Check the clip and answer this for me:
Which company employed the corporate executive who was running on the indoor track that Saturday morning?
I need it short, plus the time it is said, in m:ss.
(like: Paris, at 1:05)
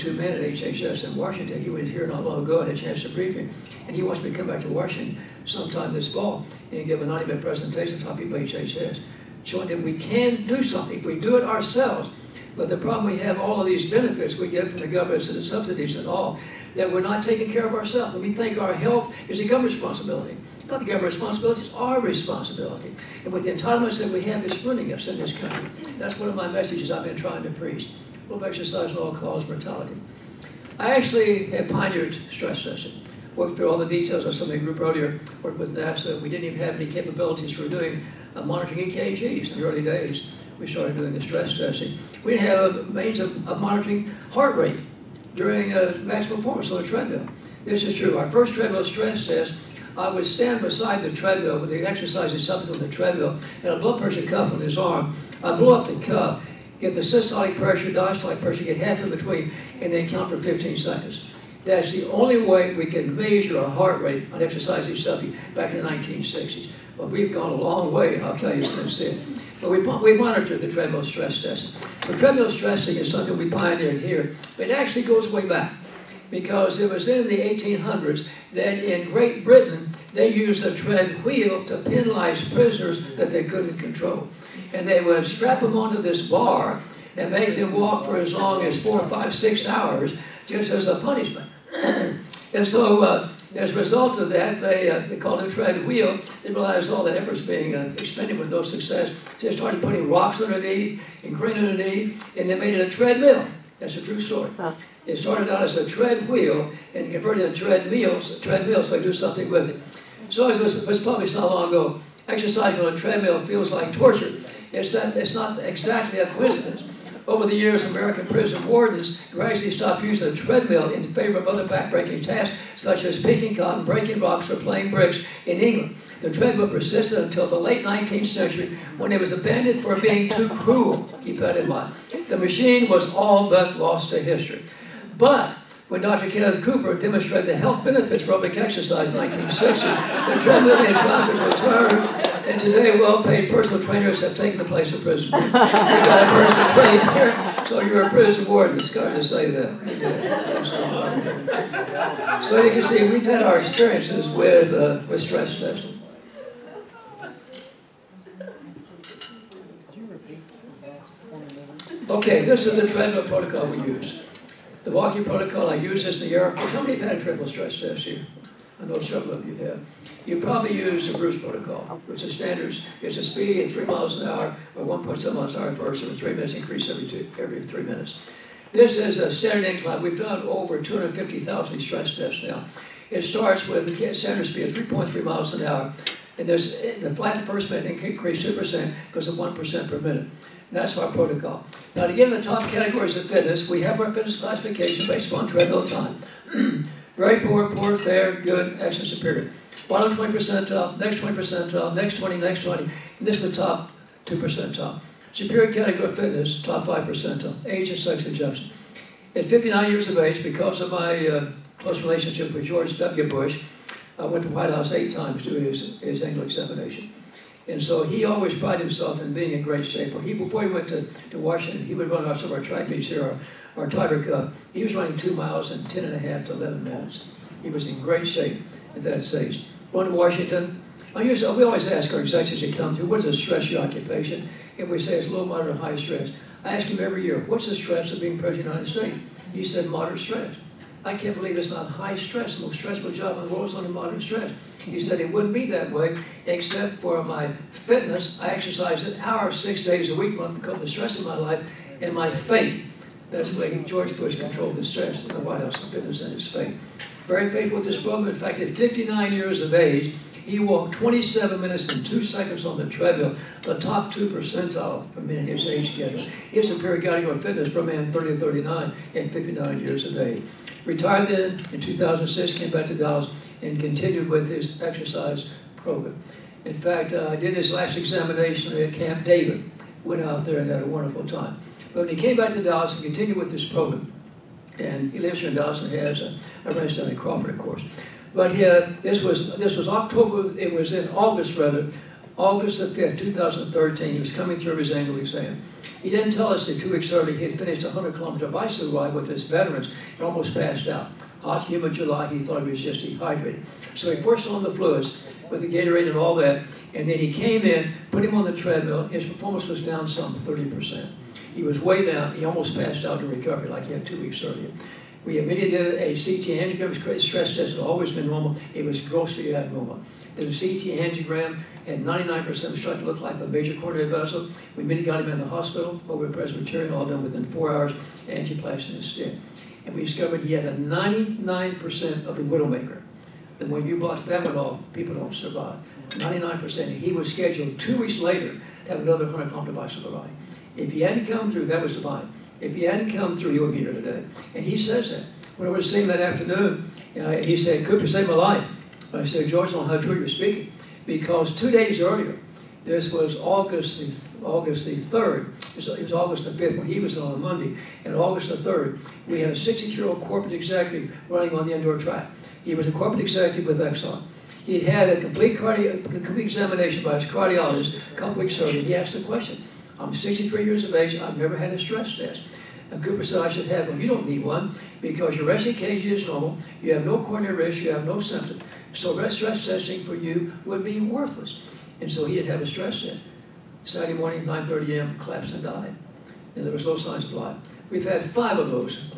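Exxon, at 6:03.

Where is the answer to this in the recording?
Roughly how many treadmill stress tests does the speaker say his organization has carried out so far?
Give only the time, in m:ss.
3:00.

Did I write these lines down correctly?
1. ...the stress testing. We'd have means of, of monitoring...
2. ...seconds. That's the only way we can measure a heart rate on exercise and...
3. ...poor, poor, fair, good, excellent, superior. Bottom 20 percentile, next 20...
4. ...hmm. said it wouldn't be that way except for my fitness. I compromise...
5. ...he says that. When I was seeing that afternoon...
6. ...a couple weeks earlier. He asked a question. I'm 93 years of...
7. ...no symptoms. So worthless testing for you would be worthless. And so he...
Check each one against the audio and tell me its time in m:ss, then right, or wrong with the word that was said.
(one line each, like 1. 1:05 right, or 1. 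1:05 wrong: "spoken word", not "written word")
1. 0:41 right
2. 1:00 right
3. 3:17 right
4. 4:04 wrong: "exercise", not "compromise"
5. 5:44 right
6. 6:08 wrong: "63", not "93"
7. 6:18 wrong: "stress", not "worthless".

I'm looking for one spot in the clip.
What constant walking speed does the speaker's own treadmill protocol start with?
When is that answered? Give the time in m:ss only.
3:04.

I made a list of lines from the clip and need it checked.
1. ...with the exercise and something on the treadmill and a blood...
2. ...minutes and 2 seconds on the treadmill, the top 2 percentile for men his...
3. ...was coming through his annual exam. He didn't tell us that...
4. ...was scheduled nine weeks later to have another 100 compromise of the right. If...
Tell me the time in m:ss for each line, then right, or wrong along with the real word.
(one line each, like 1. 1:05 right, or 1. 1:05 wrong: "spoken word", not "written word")
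1. 0:51 right
2. 4:21 right
3. 4:54 right
4. 5:37 wrong: "two", not "nine".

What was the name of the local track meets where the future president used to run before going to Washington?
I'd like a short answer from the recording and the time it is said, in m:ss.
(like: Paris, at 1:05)
Tiger Cup, at 3:43.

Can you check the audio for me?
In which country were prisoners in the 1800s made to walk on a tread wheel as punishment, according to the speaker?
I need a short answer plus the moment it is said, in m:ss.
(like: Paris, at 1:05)
Great Britain, at 1:19.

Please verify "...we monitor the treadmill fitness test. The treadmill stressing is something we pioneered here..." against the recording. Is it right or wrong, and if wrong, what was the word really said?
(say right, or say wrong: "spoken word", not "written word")
wrong: "stress", not "fitness".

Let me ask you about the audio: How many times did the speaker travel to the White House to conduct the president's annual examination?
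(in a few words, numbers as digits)
8 times.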